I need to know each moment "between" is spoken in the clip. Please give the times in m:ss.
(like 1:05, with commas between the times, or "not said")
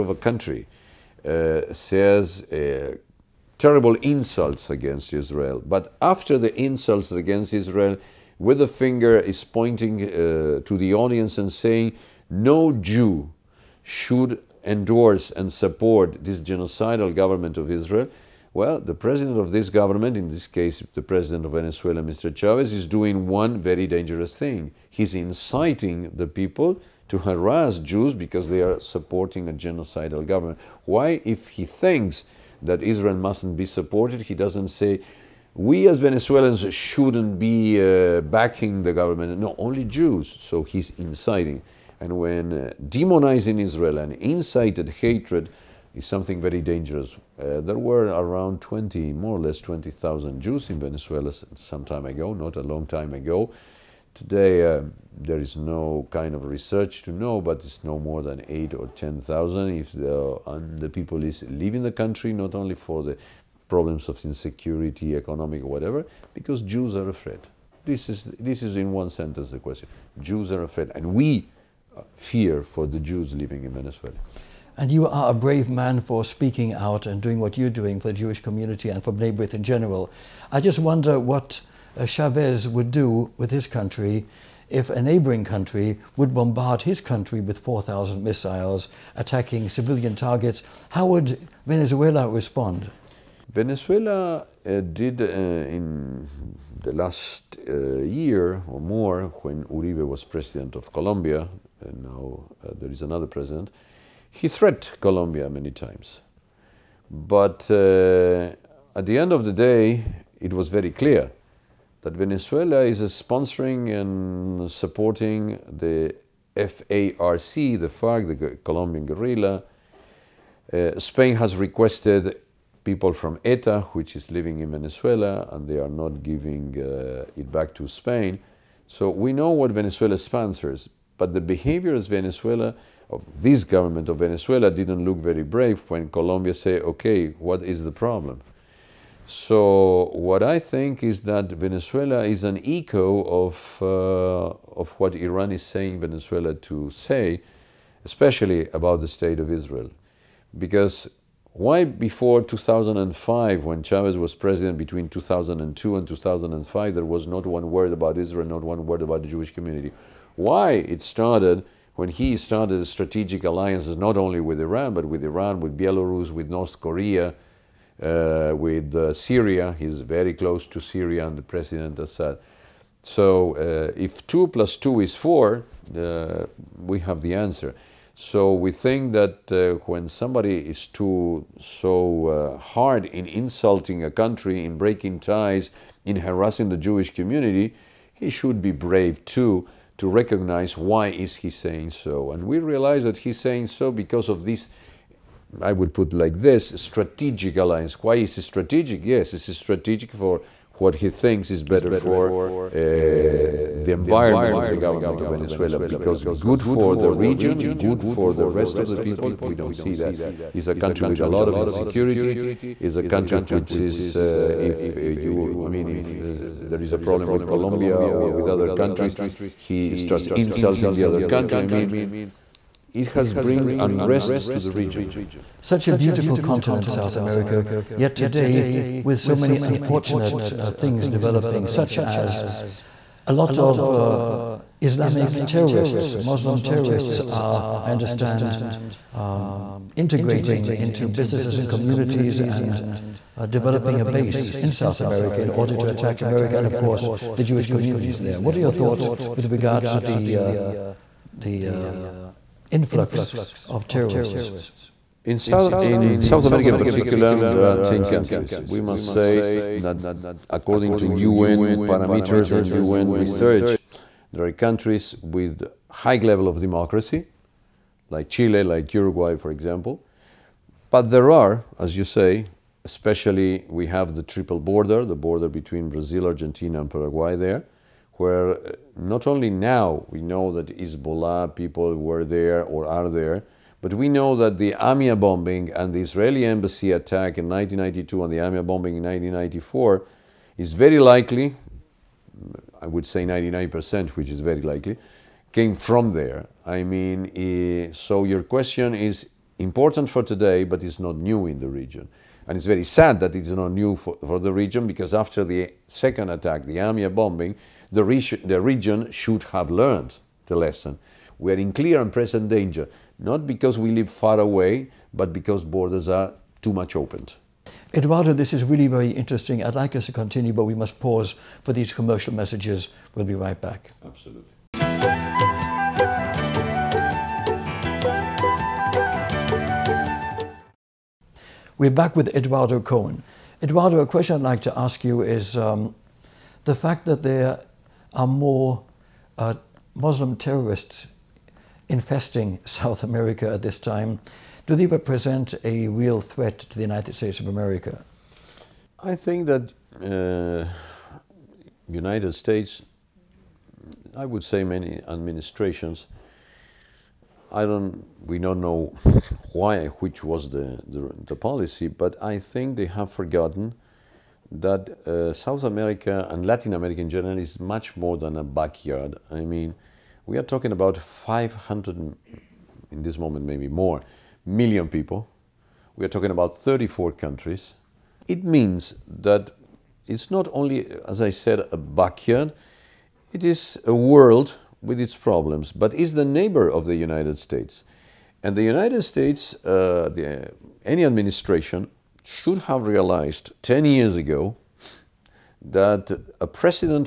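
2:34, 4:35.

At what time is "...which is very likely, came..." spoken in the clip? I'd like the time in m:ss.
4:54.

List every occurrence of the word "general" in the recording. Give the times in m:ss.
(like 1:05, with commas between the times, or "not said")
1:19, 6:07.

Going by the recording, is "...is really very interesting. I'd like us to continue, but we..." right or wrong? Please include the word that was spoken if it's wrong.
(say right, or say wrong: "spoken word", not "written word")
right.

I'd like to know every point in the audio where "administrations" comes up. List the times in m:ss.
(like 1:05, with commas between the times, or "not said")
5:55, 6:31.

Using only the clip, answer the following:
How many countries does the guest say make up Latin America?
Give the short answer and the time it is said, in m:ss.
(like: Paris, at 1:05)
34, at 6:16.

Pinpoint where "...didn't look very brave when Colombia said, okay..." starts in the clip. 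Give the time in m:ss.
2:14.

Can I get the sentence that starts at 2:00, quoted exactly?
Uh, Spain has requested people from ETA, which is living in Venezuela, and they are not giving uh, it back to Spain.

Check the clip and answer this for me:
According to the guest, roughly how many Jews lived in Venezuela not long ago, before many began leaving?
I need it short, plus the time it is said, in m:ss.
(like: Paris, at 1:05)
20,000, at 0:49.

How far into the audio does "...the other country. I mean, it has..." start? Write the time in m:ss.
3:40.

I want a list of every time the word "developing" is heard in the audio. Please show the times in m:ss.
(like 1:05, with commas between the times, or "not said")
3:51, 4:03.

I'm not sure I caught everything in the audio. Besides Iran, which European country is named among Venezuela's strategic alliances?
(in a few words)
Belarus.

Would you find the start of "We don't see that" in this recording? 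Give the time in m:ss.
3:29.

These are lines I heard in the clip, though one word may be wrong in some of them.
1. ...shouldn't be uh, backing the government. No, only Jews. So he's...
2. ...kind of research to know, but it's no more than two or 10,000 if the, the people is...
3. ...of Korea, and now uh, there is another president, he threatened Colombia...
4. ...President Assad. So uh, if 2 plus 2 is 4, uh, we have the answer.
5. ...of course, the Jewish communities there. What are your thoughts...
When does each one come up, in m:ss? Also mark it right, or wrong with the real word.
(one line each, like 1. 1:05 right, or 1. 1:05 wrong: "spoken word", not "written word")
1. 0:36 right
2. 0:56 wrong: "eight", not "two"
3. 1:40 wrong: "Colombia", not "Korea"
4. 2:51 right
5. 4:06 right.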